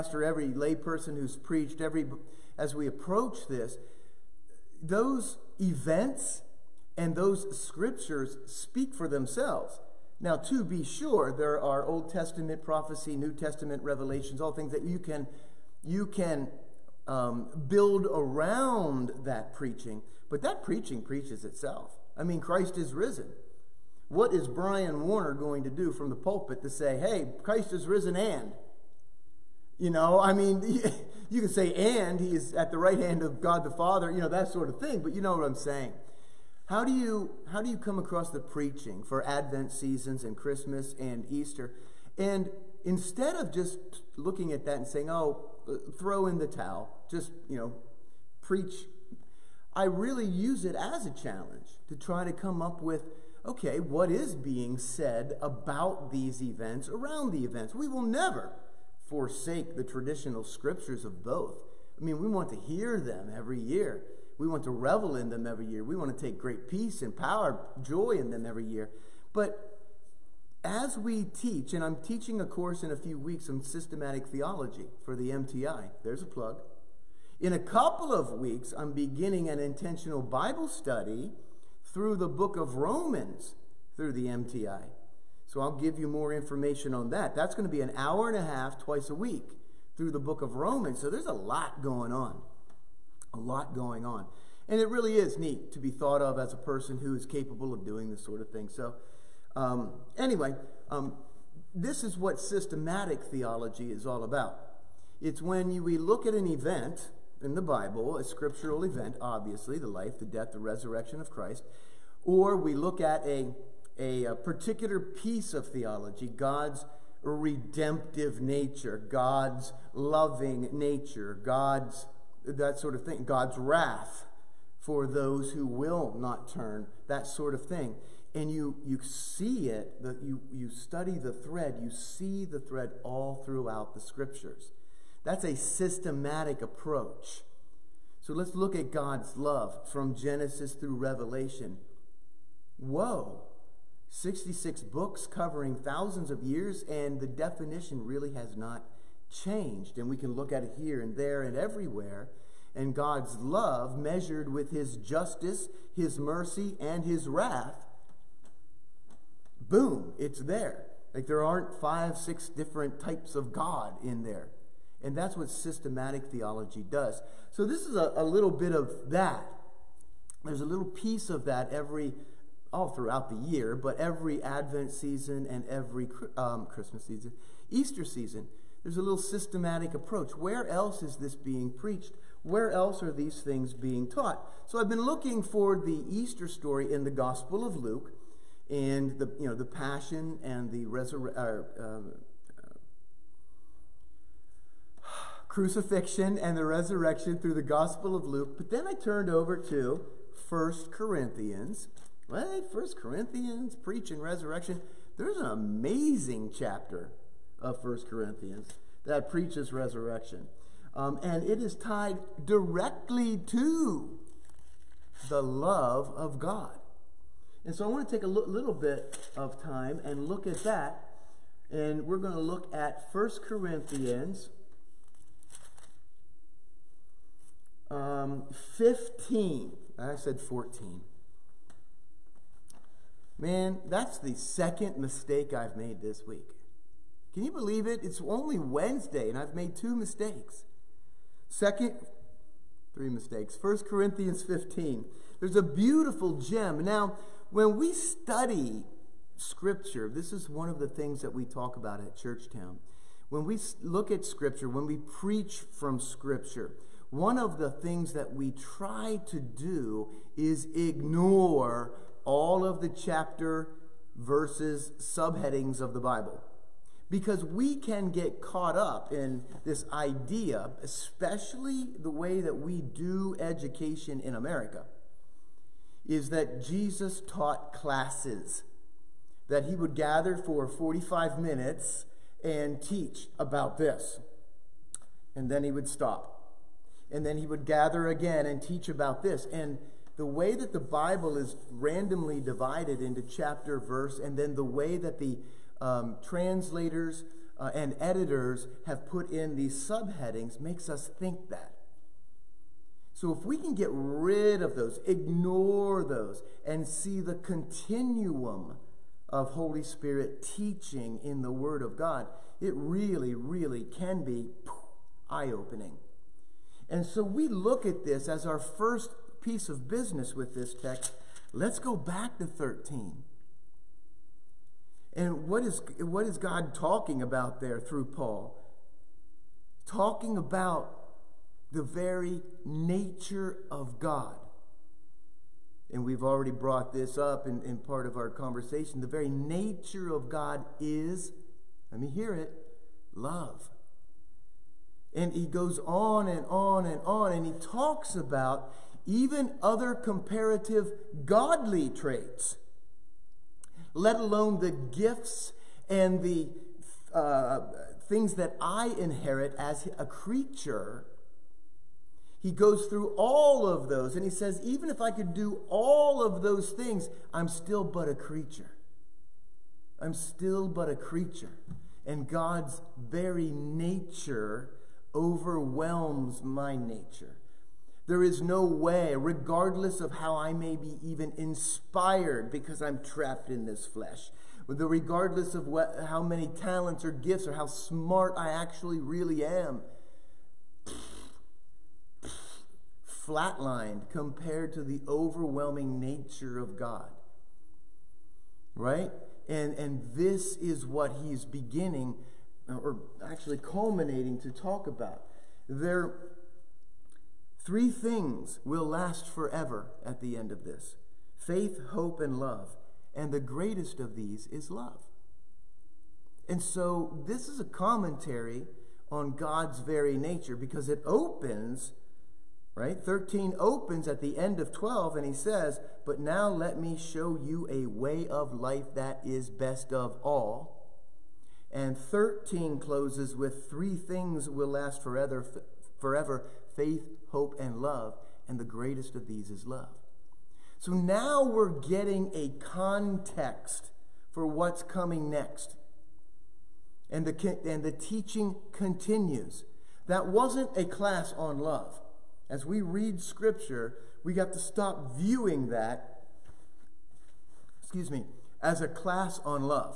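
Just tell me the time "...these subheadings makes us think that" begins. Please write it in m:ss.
4:59.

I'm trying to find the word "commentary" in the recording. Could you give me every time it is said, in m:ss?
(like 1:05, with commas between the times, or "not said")
6:57.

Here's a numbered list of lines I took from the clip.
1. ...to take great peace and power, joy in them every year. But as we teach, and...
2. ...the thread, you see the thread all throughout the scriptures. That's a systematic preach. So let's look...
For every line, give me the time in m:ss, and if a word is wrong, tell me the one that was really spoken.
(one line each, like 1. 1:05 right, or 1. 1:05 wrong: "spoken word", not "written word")
1. 1:06 right
2. 2:11 wrong: "approach", not "preach".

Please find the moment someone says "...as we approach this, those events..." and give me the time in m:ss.
0:02.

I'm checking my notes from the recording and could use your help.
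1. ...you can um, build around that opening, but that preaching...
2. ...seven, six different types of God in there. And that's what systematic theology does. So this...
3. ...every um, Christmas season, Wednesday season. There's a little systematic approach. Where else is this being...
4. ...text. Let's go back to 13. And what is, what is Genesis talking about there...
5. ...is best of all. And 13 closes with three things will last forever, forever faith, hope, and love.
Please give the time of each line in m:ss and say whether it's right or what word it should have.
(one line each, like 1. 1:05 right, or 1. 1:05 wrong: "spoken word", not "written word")
1. 0:15 wrong: "preaching", not "opening"
2. 2:41 wrong: "five", not "seven"
3. 2:55 wrong: "Easter", not "Wednesday"
4. 5:20 wrong: "God", not "Genesis"
5. 7:09 right.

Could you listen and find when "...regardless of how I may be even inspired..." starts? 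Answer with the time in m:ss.
6:19.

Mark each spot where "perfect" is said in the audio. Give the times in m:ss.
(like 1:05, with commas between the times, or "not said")
not said.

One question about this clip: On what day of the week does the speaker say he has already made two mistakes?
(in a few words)
Wednesday.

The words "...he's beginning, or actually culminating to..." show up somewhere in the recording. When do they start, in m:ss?
6:41.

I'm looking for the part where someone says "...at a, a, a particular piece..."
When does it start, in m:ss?
1:53.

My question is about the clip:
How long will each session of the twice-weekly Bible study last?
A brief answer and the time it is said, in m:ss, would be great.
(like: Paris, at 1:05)
An hour and a half, at 1:27.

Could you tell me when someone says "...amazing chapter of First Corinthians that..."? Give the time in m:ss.
3:25.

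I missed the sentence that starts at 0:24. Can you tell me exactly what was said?
What is Brian Warner going to do from the pulpit to say, hey, Christ is risen and?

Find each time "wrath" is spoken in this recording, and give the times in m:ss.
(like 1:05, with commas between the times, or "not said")
2:03, 2:37.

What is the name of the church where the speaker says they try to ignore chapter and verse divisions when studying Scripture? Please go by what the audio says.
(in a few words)
Churchtown.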